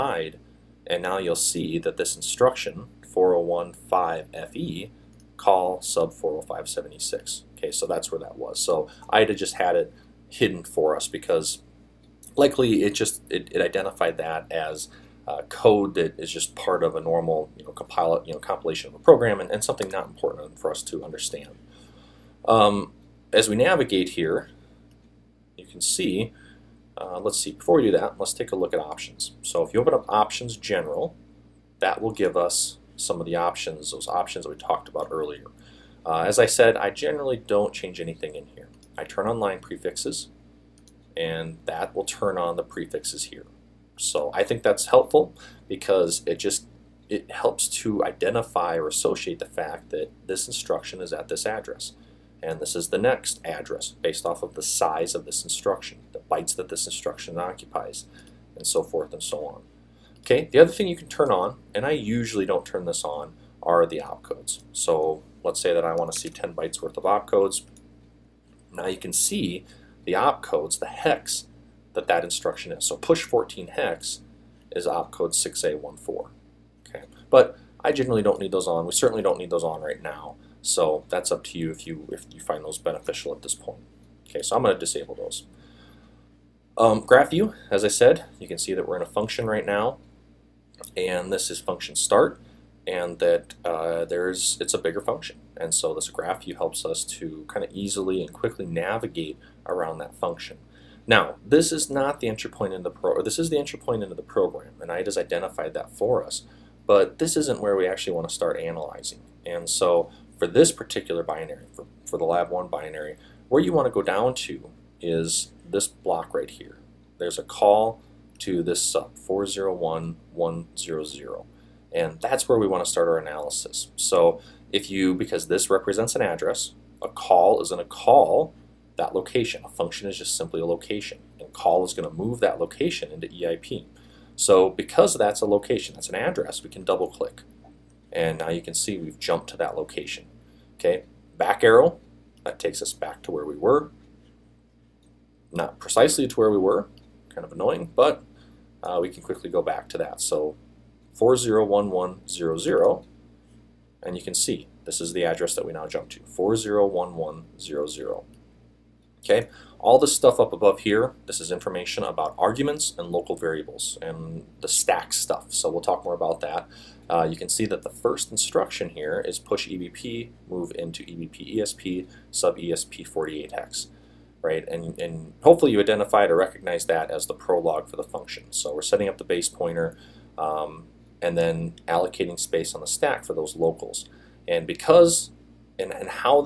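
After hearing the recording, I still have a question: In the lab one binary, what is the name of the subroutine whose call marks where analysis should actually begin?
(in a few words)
sub 401100.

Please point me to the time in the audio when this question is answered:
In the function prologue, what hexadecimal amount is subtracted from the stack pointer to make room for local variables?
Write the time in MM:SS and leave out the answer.
02:53.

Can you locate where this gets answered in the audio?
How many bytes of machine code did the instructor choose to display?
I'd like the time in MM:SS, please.
01:06.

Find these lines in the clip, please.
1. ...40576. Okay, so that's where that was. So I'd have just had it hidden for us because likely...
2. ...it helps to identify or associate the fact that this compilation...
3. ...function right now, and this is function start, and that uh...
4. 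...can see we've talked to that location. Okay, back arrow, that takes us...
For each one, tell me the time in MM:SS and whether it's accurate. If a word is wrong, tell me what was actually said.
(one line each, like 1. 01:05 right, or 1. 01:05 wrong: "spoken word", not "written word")
1. 00:06 right
2. 00:47 wrong: "instruction", not "compilation"
3. 01:29 right
4. 02:18 wrong: "jumped", not "talked".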